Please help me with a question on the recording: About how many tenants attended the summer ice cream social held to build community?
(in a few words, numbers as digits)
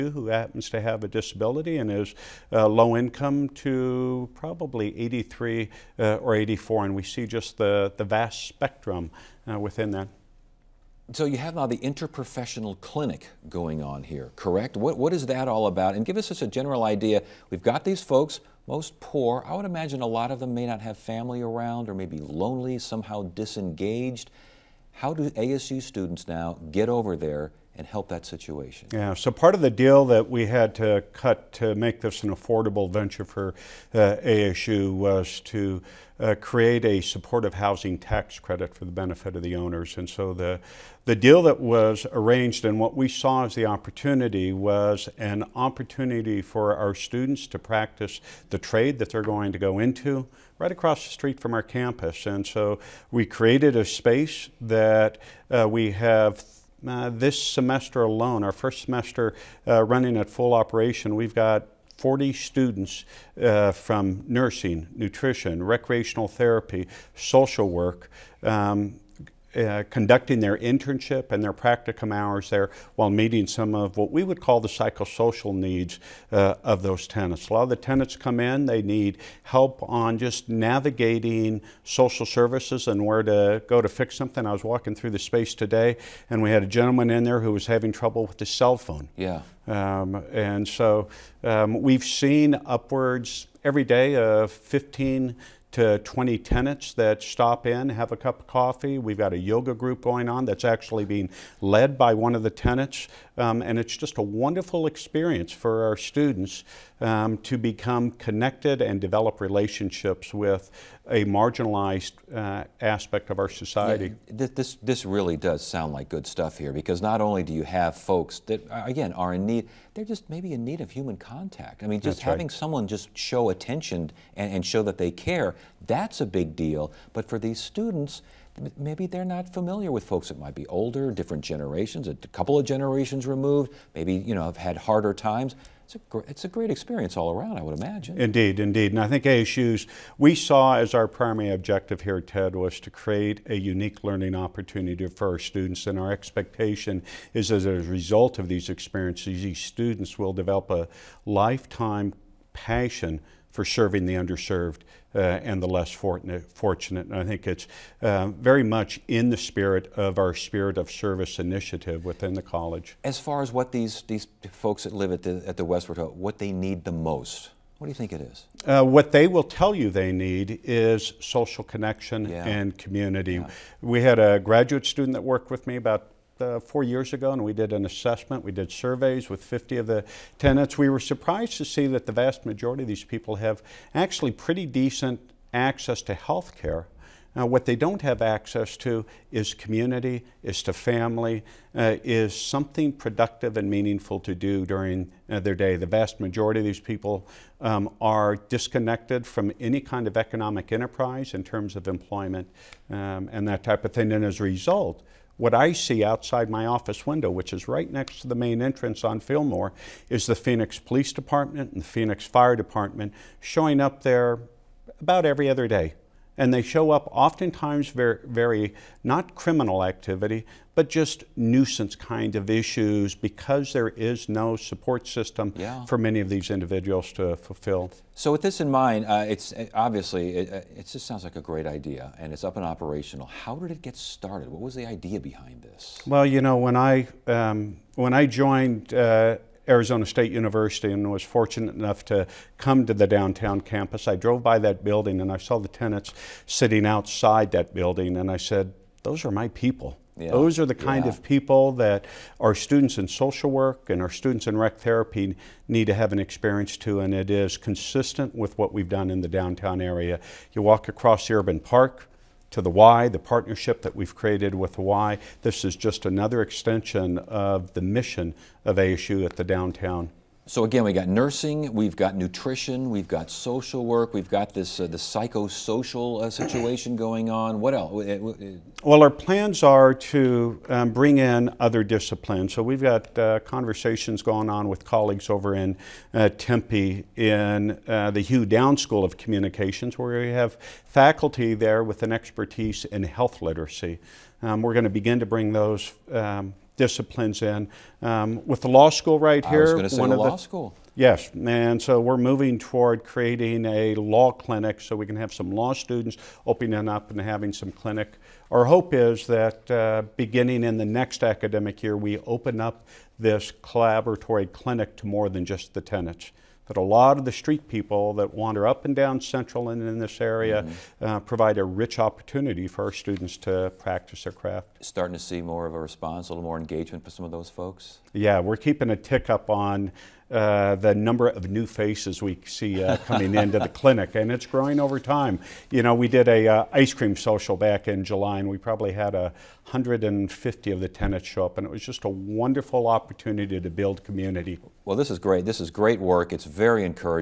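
150.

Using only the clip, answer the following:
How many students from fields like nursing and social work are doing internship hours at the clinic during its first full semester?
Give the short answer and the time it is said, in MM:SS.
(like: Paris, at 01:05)
40, at 01:01.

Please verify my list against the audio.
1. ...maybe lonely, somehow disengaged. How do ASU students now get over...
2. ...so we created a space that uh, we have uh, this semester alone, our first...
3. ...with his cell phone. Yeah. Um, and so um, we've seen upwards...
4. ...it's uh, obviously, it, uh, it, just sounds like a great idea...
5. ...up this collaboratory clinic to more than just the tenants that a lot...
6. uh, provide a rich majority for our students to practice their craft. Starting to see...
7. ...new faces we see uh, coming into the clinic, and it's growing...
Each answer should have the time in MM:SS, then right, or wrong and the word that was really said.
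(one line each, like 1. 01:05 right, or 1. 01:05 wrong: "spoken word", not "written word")
1. 00:21 right
2. 00:52 right
3. 01:28 right
4. 03:49 right
5. 05:12 right
6. 05:21 wrong: "opportunity", not "majority"
7. 05:31 right.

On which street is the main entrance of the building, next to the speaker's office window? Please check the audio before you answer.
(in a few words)
Fillmore.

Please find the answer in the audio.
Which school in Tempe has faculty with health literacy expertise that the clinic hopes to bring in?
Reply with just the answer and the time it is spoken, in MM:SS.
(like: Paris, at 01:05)
Hugh Downs School of Communications, at 04:48.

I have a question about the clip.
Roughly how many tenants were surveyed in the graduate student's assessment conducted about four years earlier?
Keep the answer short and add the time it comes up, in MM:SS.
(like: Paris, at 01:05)
50, at 02:59.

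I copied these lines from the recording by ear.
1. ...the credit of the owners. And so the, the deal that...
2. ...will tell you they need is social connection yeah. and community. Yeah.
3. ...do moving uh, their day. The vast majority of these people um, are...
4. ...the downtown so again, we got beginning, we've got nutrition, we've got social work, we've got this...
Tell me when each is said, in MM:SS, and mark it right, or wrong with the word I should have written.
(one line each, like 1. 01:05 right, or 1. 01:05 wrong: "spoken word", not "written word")
1. 00:38 wrong: "benefit", not "credit"
2. 02:49 right
3. 03:14 wrong: "during", not "moving"
4. 04:29 wrong: "nursing", not "beginning".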